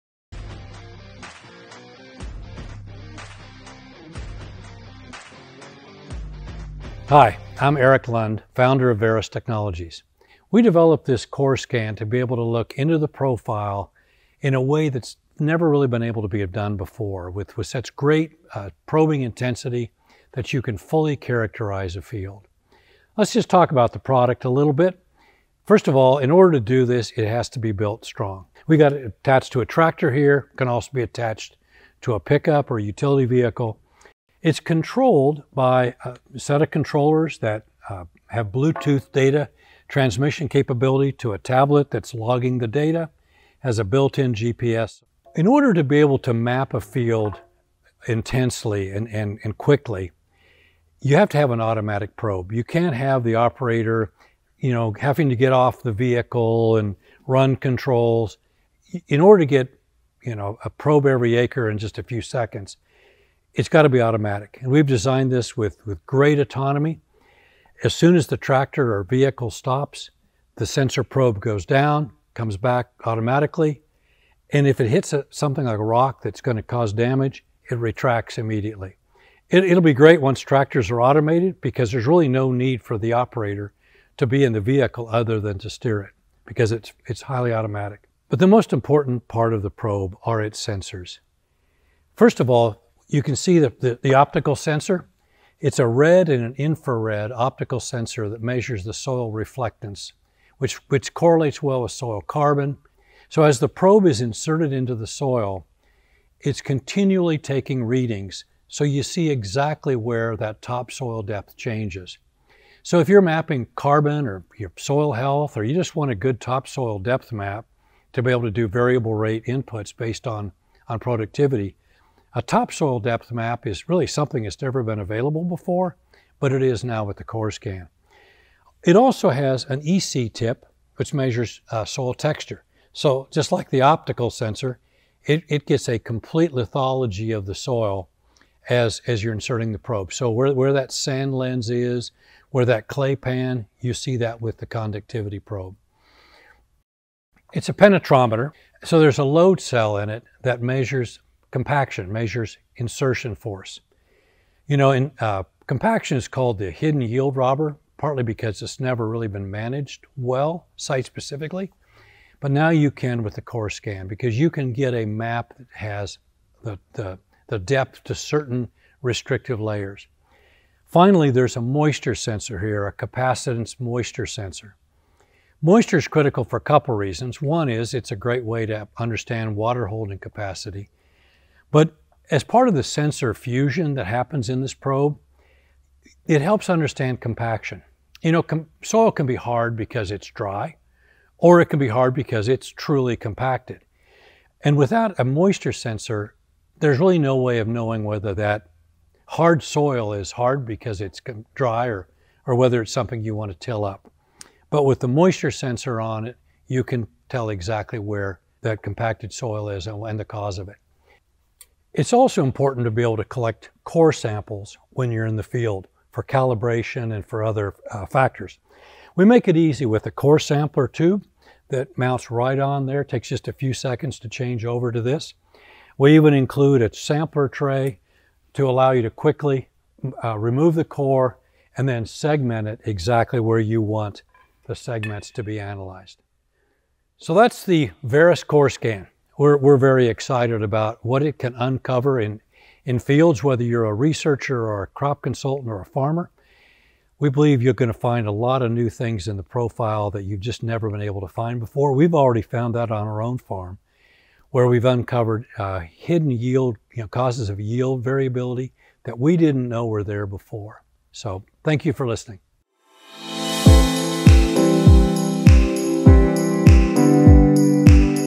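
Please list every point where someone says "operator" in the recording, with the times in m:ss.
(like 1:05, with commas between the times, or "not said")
0:53, 1:23.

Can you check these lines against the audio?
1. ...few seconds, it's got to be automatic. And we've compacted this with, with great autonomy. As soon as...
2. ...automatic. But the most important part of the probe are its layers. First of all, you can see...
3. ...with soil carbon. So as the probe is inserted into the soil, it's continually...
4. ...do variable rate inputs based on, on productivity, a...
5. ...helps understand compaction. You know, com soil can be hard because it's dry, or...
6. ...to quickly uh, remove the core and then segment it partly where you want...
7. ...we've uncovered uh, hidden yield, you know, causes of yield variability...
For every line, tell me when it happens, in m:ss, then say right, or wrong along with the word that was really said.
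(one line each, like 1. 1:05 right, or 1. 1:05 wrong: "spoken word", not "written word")
1. 1:02 wrong: "designed", not "compacted"
2. 1:27 wrong: "sensors", not "layers"
3. 1:41 right
4. 1:58 right
5. 3:06 right
6. 3:49 wrong: "exactly", not "partly"
7. 4:14 right.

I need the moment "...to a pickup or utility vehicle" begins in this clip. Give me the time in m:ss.
0:32.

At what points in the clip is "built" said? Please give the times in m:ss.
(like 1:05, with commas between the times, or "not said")
0:27, 0:43.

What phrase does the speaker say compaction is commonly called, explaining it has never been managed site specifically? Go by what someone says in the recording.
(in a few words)
The hidden yield robber.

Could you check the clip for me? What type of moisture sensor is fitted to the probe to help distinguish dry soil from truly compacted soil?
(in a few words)
Capacitance moisture sensor.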